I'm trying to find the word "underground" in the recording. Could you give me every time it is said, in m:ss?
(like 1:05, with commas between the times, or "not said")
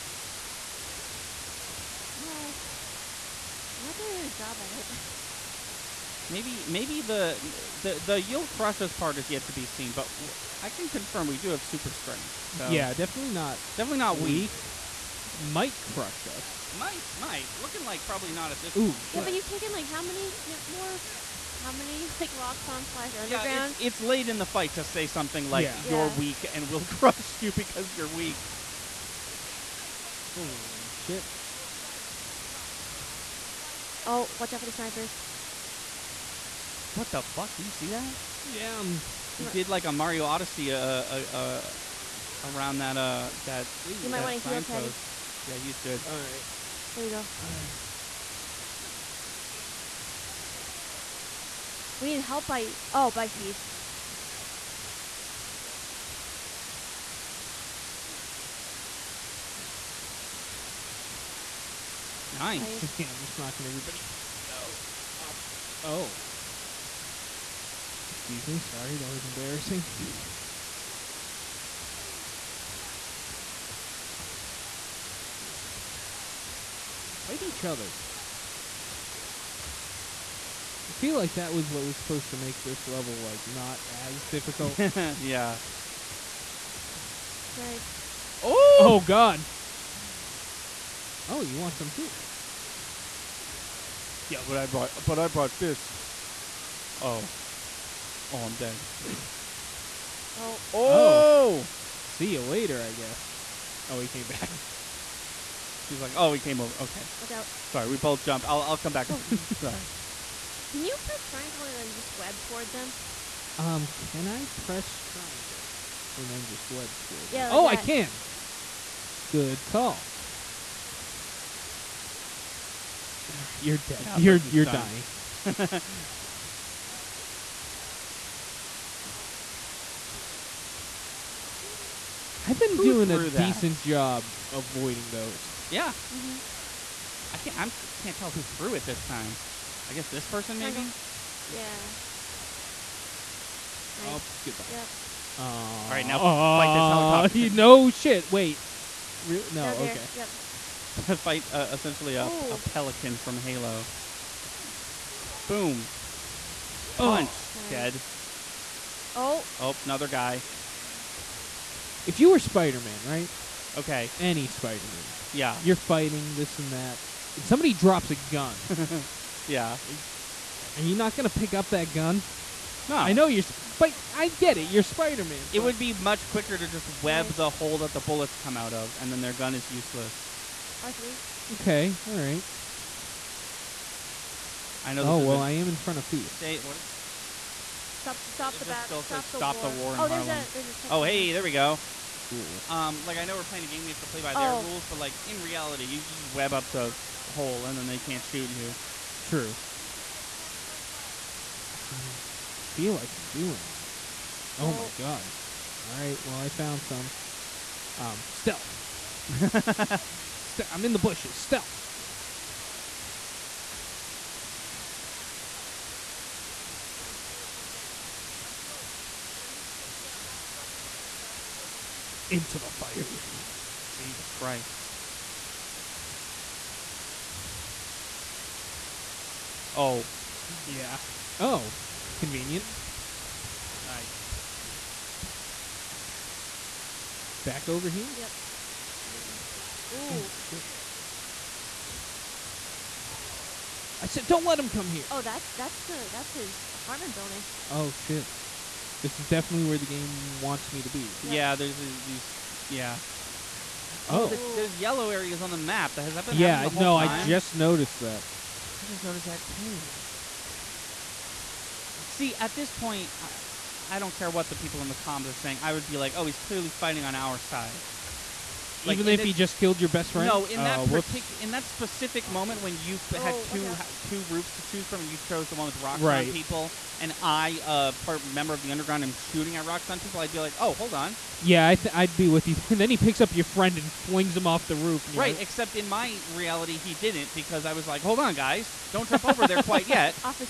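0:23, 4:38.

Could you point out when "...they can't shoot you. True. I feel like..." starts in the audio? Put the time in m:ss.
3:17.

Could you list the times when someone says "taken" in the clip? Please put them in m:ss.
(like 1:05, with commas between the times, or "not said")
0:19.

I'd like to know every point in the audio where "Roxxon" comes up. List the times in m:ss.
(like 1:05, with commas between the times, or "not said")
0:22, 4:39.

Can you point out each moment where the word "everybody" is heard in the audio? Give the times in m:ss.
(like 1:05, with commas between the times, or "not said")
1:03.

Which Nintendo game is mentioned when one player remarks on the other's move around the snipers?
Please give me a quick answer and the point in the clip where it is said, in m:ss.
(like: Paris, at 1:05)
Mario Odyssey, at 0:39.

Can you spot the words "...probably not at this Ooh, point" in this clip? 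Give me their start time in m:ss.
0:18.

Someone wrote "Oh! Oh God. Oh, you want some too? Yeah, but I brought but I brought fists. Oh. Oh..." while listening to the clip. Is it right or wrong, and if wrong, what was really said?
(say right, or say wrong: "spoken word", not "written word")
right.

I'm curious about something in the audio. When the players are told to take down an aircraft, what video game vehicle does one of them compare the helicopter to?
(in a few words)
Pelican from Halo.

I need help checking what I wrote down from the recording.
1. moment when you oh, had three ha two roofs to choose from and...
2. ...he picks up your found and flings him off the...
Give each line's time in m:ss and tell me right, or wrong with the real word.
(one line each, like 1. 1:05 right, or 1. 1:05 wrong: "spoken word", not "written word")
1. 4:32 wrong: "two", not "three"
2. 4:42 wrong: "friend", not "found".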